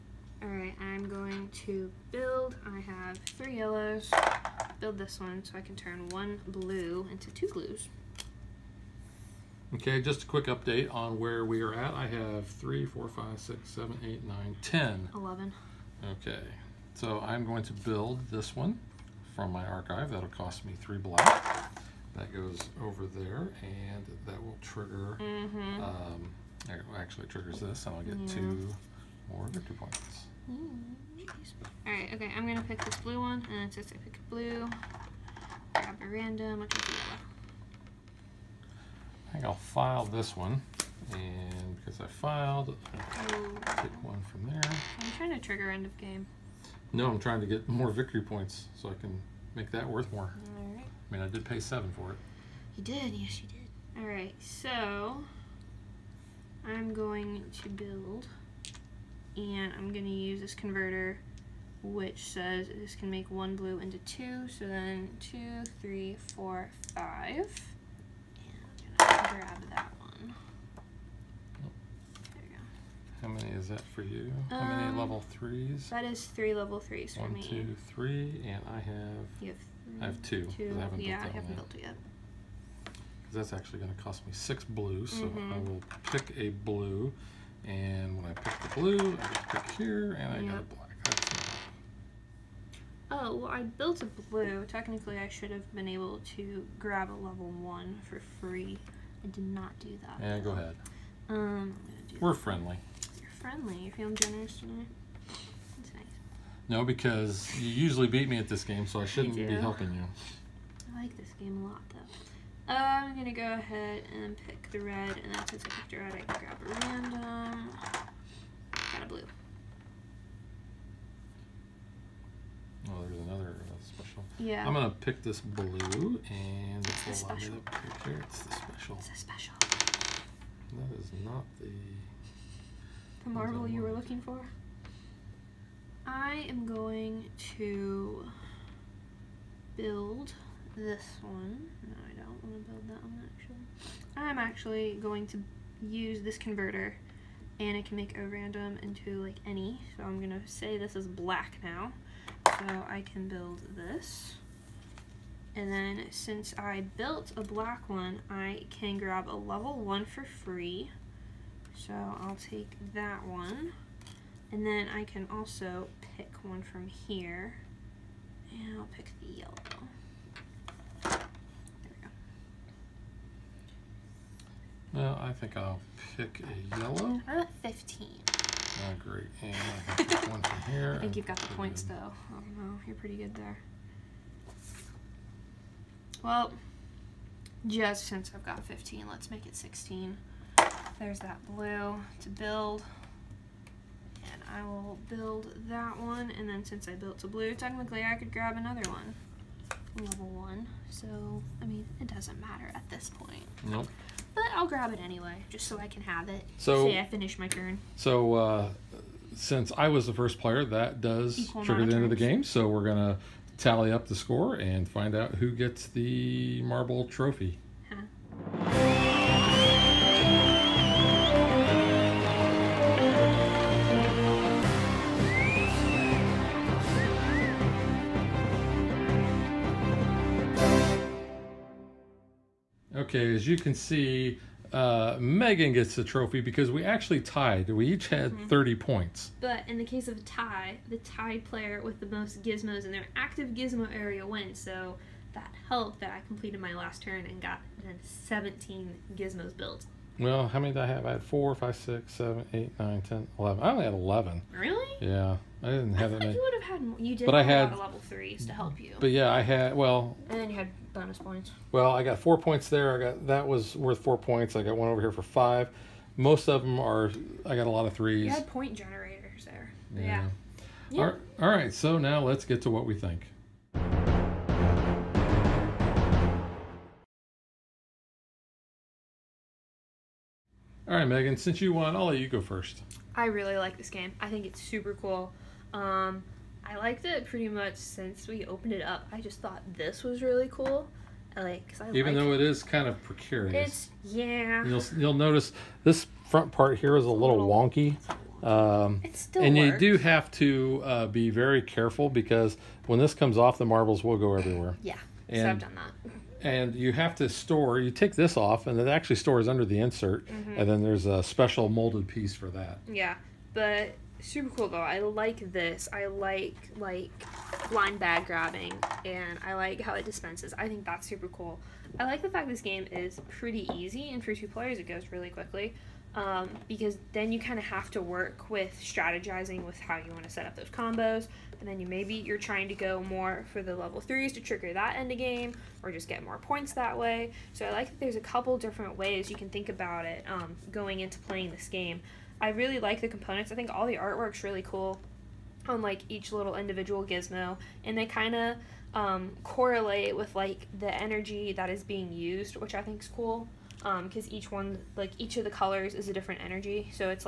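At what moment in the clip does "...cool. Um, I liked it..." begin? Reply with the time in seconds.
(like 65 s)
284 s.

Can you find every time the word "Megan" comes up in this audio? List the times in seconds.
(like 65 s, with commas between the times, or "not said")
235 s, 281 s.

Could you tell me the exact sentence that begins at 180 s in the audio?
I think you've got the points, though.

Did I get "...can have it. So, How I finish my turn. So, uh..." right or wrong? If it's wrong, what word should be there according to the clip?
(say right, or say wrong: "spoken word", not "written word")
wrong: "Say", not "How".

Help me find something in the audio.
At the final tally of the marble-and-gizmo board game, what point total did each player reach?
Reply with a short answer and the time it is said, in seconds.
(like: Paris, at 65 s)
30, at 238 s.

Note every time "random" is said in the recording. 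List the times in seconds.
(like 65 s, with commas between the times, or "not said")
36 s, 116 s, 148 s.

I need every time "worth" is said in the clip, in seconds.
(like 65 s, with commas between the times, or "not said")
49 s, 263 s.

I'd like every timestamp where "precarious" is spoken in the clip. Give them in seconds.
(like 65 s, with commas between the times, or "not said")
293 s.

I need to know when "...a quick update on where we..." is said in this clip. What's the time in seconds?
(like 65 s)
10 s.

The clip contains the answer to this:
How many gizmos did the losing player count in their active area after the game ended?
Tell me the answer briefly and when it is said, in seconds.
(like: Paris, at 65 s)
11, at 253 s.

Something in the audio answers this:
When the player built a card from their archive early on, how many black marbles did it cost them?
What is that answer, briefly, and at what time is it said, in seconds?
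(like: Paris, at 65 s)
3, at 20 s.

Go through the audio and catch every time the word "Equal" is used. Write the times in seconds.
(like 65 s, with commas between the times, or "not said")
211 s.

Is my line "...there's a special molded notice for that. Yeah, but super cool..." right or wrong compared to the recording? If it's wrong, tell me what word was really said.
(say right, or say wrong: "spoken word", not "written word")
wrong: "piece", not "notice".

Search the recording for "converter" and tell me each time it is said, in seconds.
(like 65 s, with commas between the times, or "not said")
60 s, 146 s.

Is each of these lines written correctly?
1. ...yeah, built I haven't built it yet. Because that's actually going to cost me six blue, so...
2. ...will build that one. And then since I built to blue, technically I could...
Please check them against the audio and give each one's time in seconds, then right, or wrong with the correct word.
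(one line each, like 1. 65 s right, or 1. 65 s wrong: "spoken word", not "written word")
1. 81 s right
2. 194 s right.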